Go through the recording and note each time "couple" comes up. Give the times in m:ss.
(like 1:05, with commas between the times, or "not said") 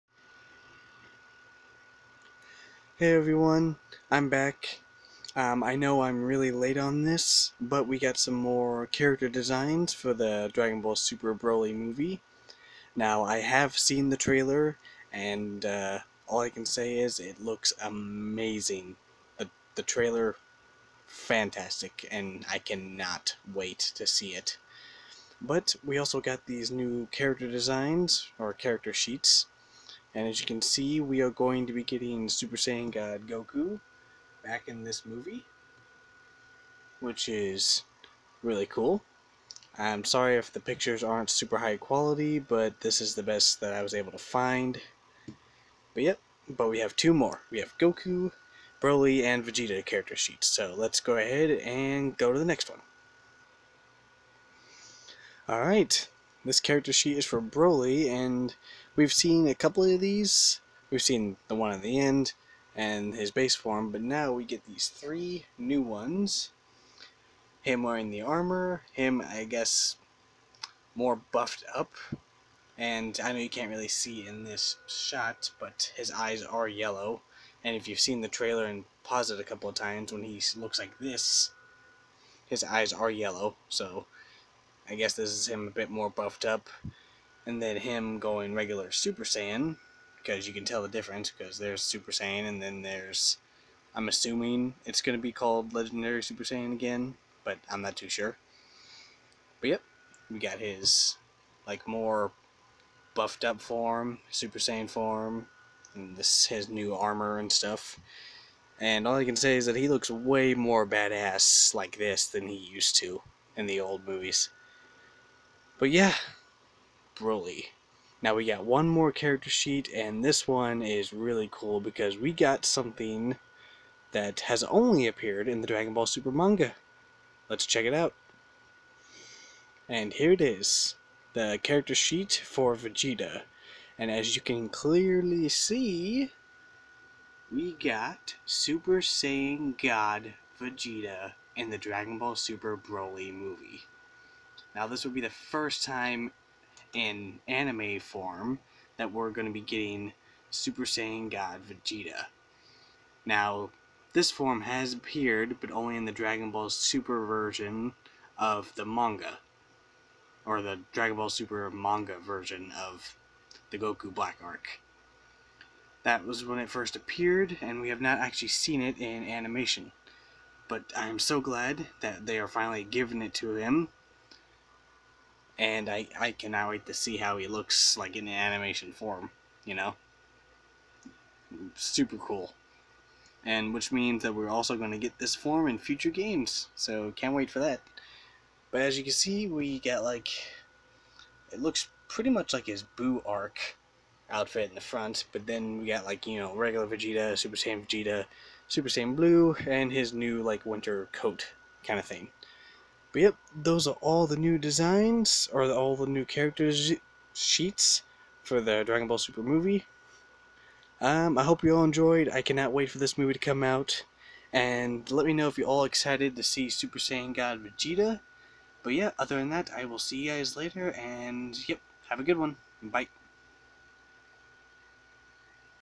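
0:59, 1:19.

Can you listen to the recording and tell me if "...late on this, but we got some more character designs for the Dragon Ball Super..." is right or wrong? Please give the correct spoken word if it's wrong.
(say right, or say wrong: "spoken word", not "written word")
right.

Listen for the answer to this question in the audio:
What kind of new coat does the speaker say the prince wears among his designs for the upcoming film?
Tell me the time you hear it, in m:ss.
3:20.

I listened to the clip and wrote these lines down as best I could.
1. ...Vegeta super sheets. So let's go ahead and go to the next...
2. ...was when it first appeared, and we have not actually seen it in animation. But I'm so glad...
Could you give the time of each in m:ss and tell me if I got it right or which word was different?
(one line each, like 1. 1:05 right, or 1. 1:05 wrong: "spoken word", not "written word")
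1. 0:49 wrong: "character", not "super"
2. 2:46 right.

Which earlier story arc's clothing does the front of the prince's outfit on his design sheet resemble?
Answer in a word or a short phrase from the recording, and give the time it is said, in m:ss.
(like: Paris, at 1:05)
Boo arc, at 3:12.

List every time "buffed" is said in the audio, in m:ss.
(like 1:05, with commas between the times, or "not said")
1:11, 1:26, 1:43.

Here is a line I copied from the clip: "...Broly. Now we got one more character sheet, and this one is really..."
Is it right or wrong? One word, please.
right.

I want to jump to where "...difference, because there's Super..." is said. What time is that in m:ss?
1:30.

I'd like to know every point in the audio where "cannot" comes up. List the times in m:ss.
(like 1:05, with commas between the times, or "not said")
0:22, 2:56, 3:32.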